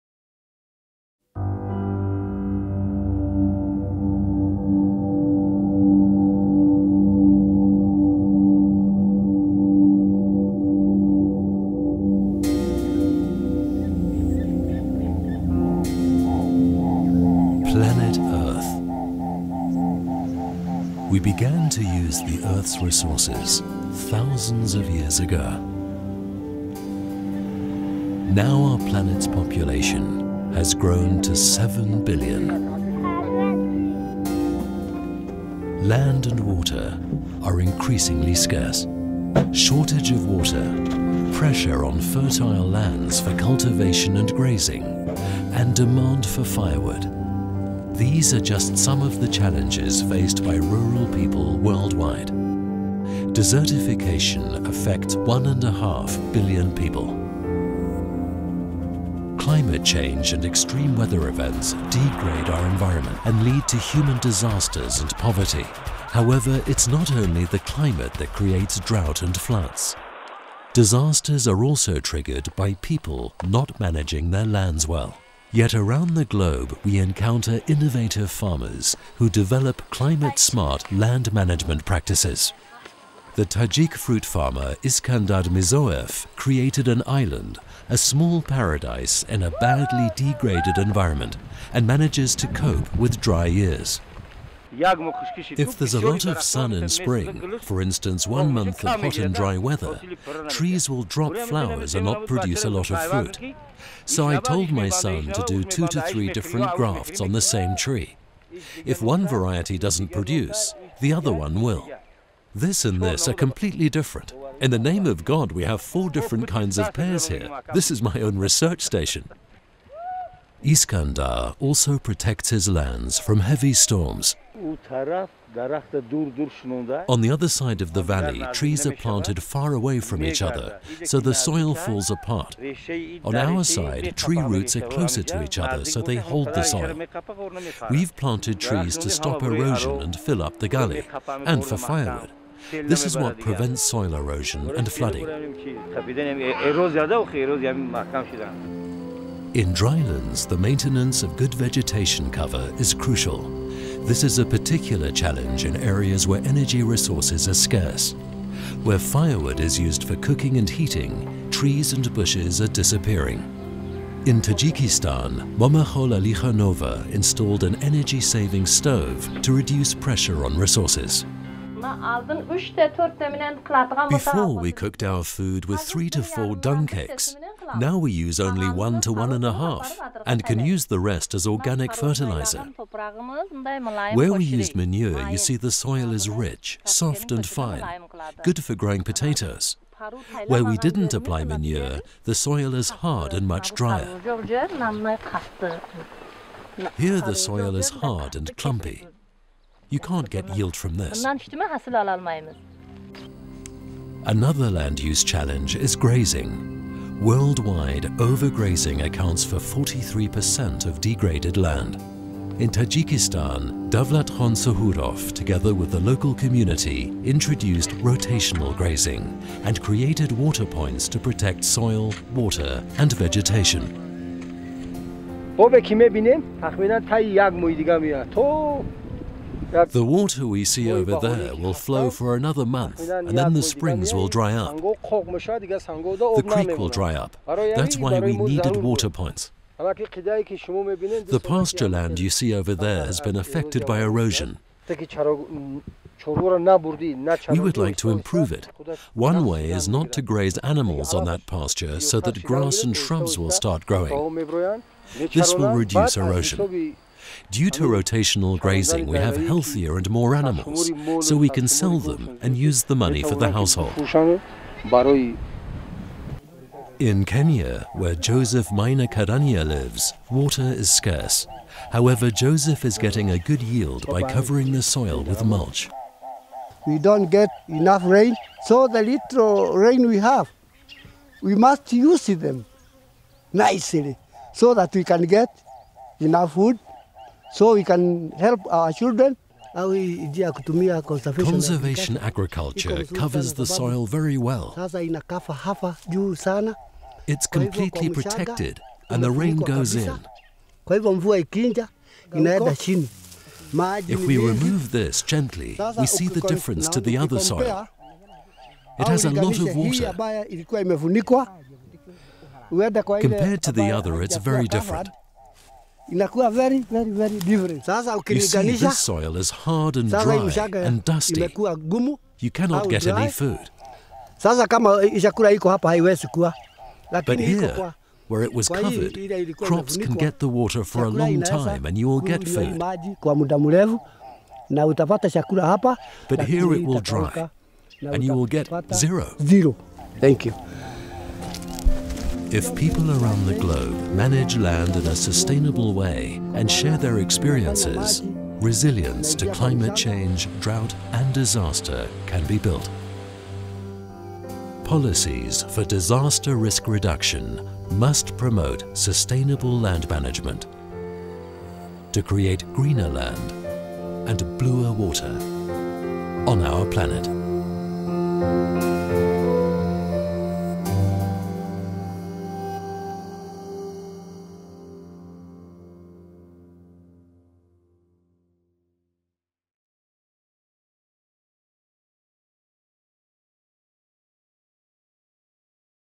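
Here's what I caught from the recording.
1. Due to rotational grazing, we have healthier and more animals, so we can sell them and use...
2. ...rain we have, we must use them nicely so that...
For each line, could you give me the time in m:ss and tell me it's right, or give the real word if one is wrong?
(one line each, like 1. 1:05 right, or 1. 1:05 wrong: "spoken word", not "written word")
1. 4:17 right
2. 4:39 right.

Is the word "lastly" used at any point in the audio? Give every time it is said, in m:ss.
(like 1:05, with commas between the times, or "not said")
not said.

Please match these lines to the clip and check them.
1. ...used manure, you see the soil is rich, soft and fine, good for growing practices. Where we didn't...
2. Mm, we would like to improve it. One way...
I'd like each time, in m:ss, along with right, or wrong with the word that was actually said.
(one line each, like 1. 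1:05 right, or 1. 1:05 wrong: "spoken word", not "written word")
1. 3:04 wrong: "potatoes", not "practices"
2. 4:04 right.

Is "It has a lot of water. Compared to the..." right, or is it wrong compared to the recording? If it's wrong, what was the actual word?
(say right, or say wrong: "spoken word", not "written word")
right.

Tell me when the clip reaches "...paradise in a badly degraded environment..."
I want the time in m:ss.
1:28.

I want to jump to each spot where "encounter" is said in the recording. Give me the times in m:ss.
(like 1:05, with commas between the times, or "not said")
1:16.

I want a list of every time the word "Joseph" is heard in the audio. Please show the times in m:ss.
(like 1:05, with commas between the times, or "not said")
4:28, 4:32.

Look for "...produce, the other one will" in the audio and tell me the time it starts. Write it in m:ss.
1:50.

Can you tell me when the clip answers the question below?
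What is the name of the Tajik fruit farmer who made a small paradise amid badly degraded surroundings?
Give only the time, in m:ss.
1:24.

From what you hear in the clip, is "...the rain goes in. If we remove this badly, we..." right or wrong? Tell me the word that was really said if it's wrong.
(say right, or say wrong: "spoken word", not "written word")
wrong: "gently", not "badly".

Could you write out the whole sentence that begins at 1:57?
This is my own research station.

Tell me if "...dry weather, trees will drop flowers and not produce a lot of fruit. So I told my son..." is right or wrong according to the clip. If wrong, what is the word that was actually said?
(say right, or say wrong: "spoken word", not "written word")
right.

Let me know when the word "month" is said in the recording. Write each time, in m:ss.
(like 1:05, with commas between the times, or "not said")
1:38, 3:52.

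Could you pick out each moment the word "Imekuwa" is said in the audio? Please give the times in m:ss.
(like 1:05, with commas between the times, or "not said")
5:21.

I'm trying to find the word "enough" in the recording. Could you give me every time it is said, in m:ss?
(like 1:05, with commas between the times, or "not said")
4:37, 4:46.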